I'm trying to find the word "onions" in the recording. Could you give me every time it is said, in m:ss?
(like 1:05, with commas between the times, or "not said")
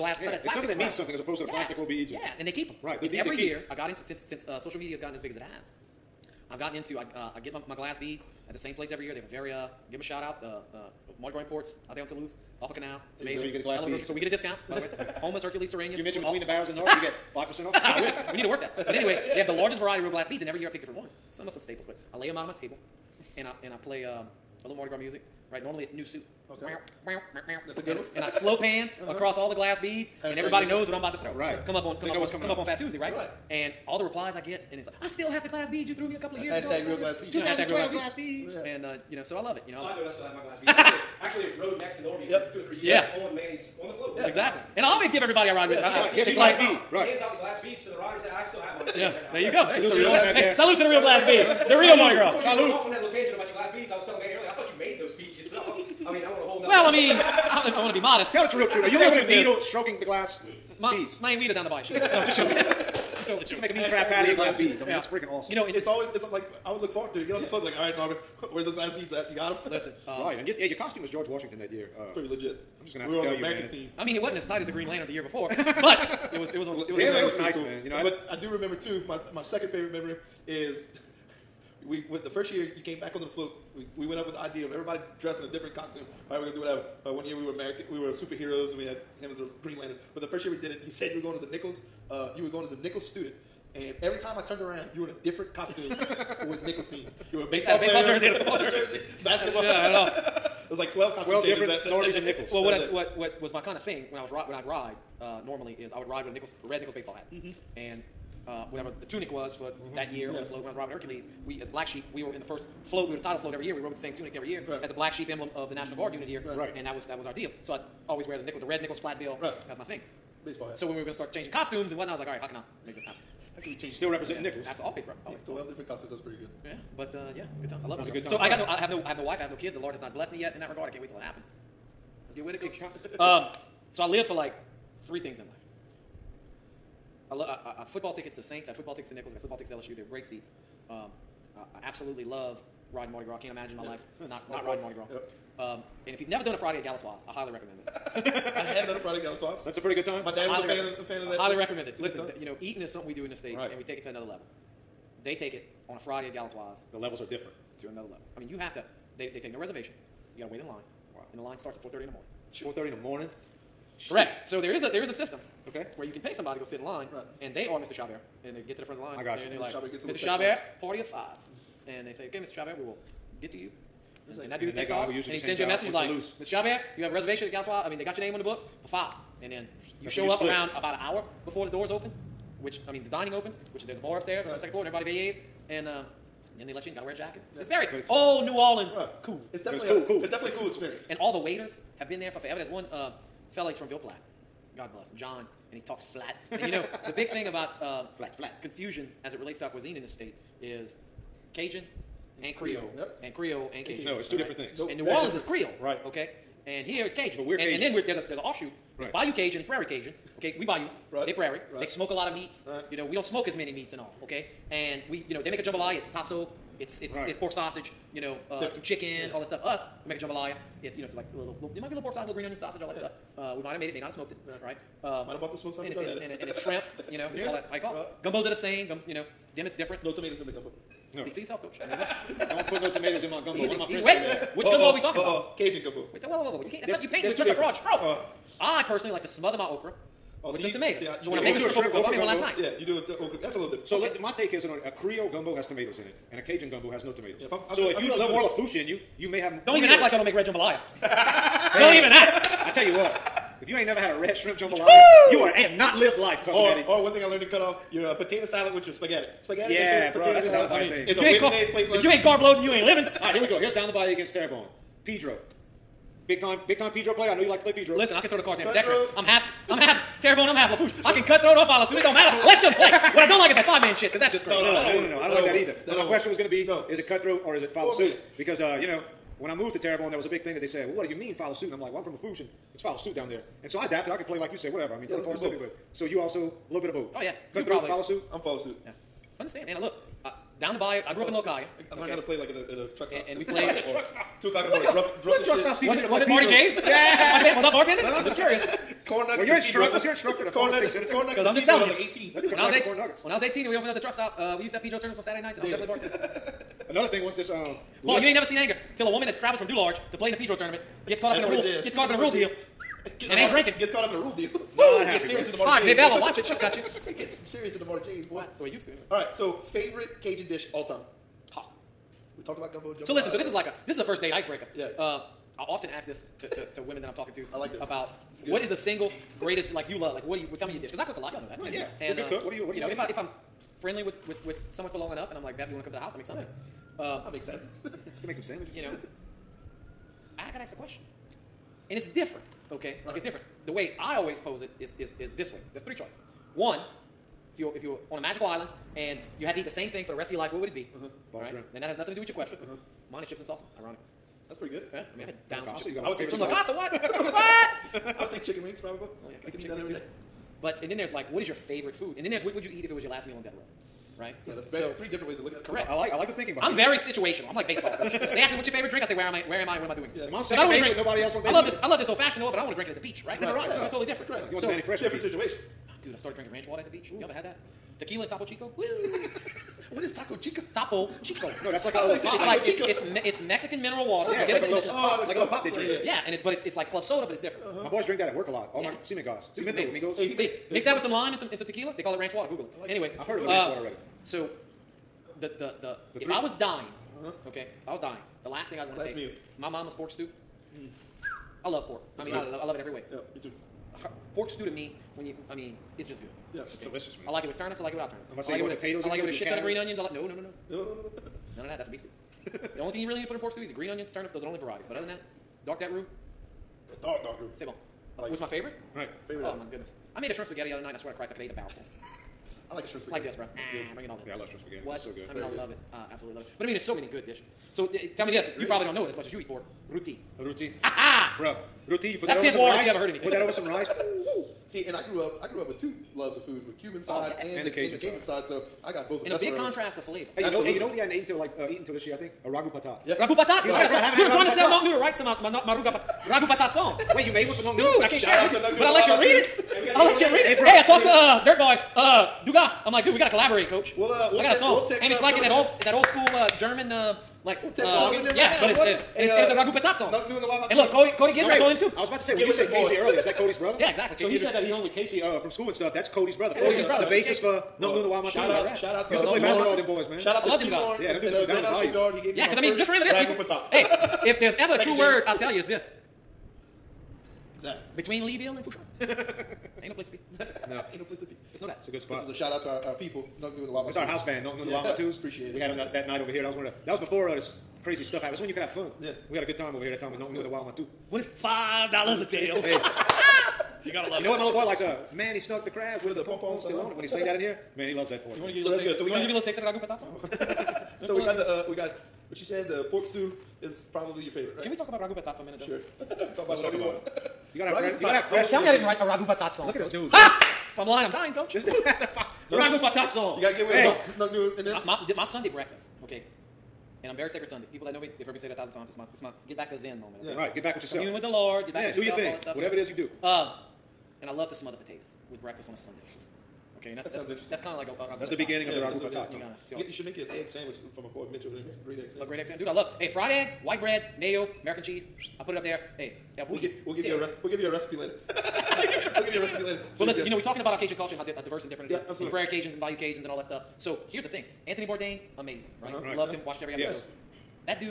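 3:42, 6:49, 6:53.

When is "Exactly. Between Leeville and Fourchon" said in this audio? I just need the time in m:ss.
7:57.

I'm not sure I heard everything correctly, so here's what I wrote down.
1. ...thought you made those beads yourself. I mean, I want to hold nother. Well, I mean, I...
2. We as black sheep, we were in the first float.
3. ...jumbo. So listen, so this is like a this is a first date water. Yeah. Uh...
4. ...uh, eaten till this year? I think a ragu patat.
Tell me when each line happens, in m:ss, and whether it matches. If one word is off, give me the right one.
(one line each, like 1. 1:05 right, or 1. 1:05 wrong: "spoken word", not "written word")
1. 0:54 right
2. 1:51 right
3. 5:22 wrong: "icebreaker", not "water"
4. 7:21 right.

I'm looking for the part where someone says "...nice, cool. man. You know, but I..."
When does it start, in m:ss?
1:17.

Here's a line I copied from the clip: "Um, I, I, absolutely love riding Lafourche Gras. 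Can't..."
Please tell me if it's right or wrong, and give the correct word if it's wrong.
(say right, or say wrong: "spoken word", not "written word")
wrong: "Mardi", not "Lafourche".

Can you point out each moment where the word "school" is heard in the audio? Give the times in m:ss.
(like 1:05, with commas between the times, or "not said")
7:36, 7:45.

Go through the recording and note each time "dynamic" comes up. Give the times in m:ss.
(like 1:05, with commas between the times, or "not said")
not said.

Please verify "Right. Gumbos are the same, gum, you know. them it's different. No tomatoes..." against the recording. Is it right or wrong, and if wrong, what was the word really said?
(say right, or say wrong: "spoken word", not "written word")
right.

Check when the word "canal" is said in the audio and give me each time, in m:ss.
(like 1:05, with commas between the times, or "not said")
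0:12.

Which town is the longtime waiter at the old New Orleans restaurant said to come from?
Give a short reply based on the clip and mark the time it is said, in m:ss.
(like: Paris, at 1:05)
Ville Platte, at 3:13.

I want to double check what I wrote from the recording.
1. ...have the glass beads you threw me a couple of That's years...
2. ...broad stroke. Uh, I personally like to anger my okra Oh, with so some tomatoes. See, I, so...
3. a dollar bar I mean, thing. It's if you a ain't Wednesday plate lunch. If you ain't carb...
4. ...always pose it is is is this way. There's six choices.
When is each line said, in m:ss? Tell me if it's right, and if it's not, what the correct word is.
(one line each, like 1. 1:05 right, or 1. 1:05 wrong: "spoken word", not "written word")
1. 0:35 right
2. 3:57 wrong: "smother", not "anger"
3. 4:20 right
4. 5:44 wrong: "three", not "six".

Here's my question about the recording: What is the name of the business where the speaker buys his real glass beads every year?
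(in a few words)
Mardi Gras Imports.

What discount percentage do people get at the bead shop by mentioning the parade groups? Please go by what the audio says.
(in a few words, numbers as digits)
5%.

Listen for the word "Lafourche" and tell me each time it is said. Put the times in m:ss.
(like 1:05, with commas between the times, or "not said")
4:08, 4:30, 4:42.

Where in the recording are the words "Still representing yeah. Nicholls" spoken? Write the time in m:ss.
2:03.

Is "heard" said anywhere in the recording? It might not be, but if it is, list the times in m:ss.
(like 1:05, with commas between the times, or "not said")
6:33, 7:12, 8:38.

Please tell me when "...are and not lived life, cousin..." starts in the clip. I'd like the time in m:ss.
4:15.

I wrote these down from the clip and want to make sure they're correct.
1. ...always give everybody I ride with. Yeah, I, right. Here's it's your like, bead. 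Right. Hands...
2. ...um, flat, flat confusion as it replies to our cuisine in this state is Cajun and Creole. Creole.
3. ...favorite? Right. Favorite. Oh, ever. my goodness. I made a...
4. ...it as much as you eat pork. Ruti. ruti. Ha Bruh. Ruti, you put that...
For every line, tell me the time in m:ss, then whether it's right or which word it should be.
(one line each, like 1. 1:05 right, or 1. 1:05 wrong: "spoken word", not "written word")
1. 0:44 right
2. 3:17 wrong: "relates", not "replies"
3. 6:58 right
4. 7:09 right.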